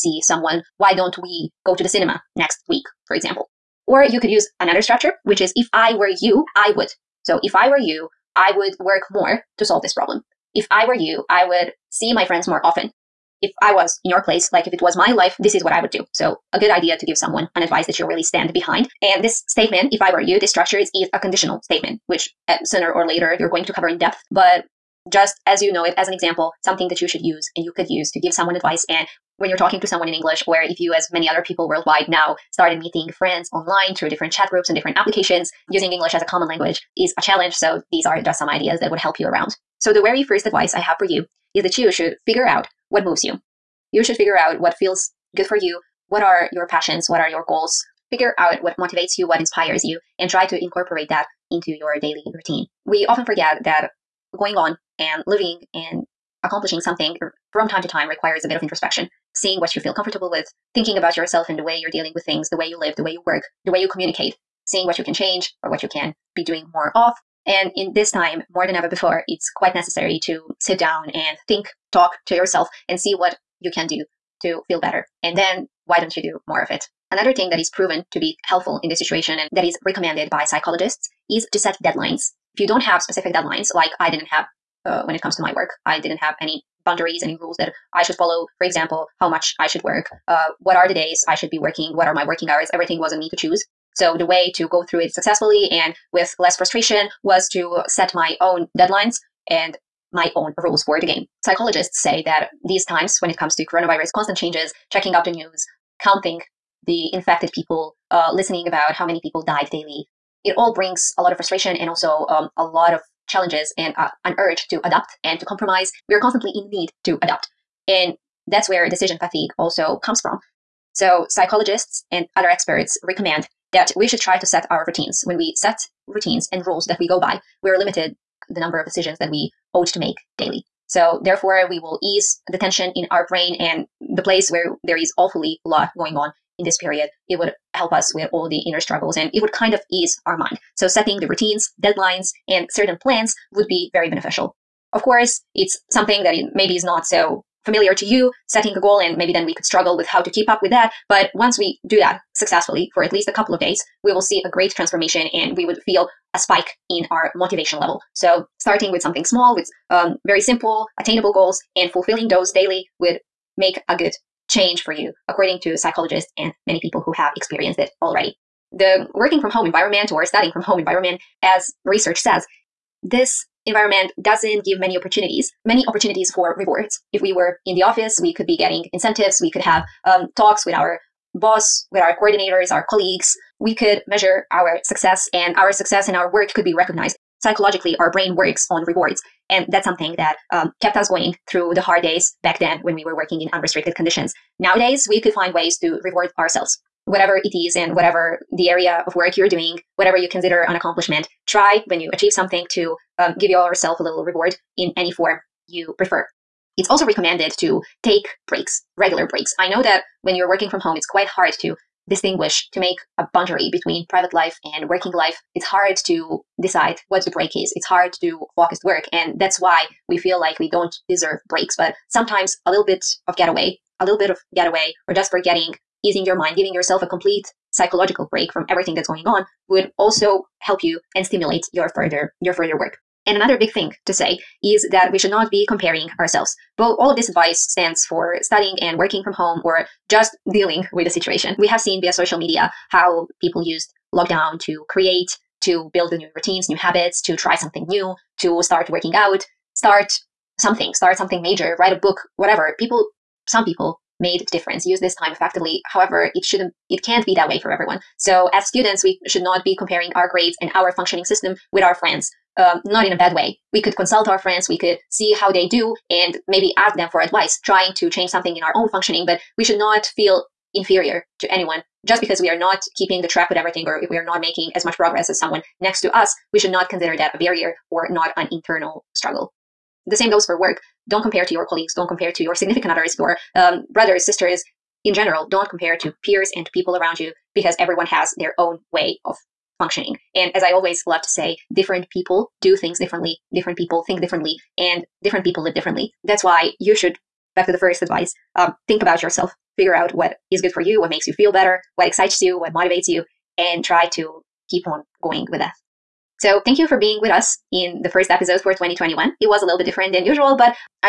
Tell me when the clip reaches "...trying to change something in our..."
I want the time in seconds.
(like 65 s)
267 s.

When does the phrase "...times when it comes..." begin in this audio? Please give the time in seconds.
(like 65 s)
102 s.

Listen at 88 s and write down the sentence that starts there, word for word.
For example, how much I should work, uh, what are the days I should be working, what are my working hours.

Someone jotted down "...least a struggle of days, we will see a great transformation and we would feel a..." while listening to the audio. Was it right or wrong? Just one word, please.
wrong.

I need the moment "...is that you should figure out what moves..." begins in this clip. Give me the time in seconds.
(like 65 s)
41 s.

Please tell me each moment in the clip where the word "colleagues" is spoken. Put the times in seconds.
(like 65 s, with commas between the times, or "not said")
182 s, 281 s.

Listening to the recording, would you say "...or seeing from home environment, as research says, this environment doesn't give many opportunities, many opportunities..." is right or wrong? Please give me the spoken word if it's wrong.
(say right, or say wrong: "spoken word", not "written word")
wrong: "studying", not "seeing".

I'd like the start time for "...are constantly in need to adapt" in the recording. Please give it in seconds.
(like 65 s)
116 s.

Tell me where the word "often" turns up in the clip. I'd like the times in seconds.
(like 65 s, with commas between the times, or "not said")
12 s, 53 s.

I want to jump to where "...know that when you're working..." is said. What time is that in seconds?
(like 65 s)
209 s.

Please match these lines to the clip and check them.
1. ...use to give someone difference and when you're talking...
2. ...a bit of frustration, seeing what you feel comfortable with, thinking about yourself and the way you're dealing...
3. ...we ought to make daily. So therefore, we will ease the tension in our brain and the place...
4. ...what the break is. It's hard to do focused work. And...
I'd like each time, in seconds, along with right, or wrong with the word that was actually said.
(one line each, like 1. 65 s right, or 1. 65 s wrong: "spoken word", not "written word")
1. 27 s wrong: "advice", not "difference"
2. 58 s wrong: "introspection", not "frustration"
3. 129 s right
4. 217 s right.